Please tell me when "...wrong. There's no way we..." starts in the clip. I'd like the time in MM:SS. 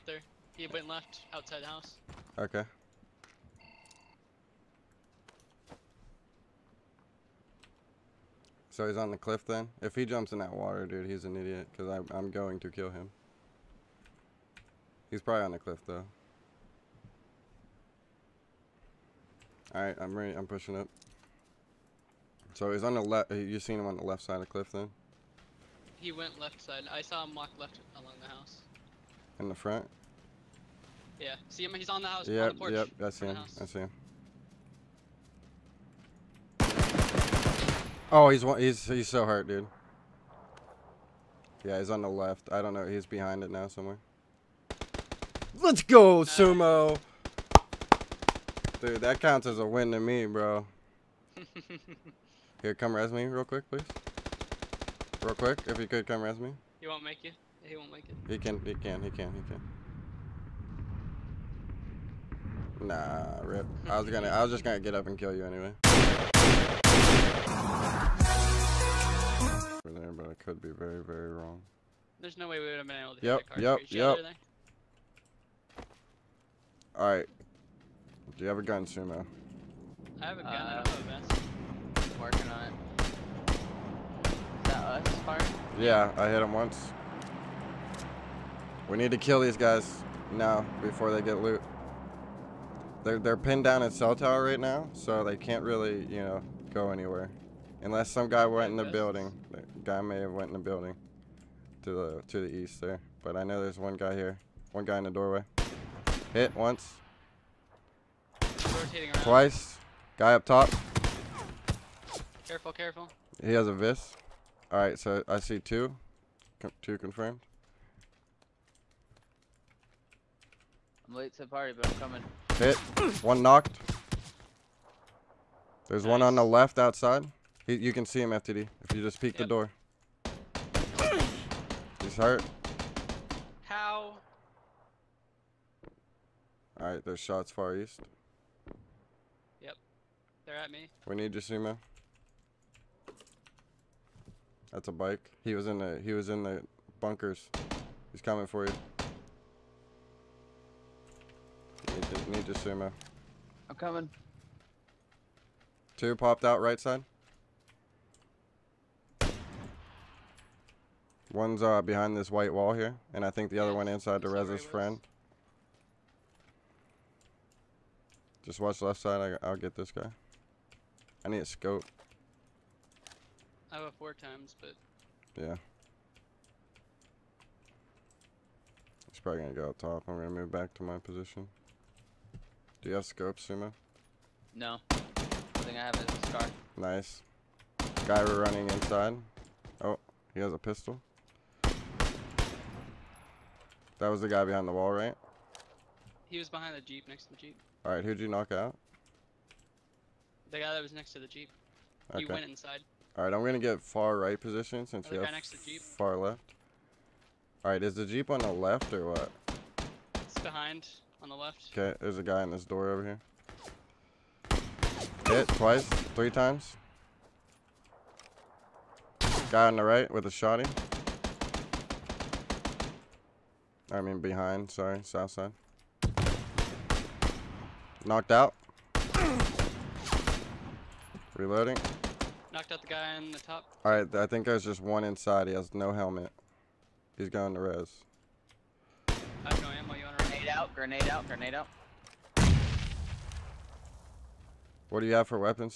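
01:11.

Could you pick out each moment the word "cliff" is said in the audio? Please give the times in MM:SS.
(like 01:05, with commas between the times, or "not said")
00:09, 00:15, 00:24.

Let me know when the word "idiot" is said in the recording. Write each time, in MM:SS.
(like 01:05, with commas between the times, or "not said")
00:11.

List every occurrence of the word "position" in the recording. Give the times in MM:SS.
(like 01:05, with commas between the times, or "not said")
03:00, 03:24.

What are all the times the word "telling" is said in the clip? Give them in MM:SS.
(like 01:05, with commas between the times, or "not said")
not said.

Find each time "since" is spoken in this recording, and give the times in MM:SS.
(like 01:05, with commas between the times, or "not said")
03:24.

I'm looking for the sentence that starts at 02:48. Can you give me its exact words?
Just watch left side, I, will get this guy.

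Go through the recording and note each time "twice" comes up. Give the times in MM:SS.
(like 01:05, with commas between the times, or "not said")
01:49, 03:35.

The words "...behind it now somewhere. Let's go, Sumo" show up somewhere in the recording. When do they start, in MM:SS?
00:43.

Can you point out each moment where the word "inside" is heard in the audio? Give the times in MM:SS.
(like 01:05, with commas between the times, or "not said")
02:43, 03:08, 03:22, 03:55.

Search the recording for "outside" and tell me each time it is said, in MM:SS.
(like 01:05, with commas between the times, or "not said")
00:01, 02:06.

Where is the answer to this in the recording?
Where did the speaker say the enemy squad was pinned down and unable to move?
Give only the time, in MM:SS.
01:33.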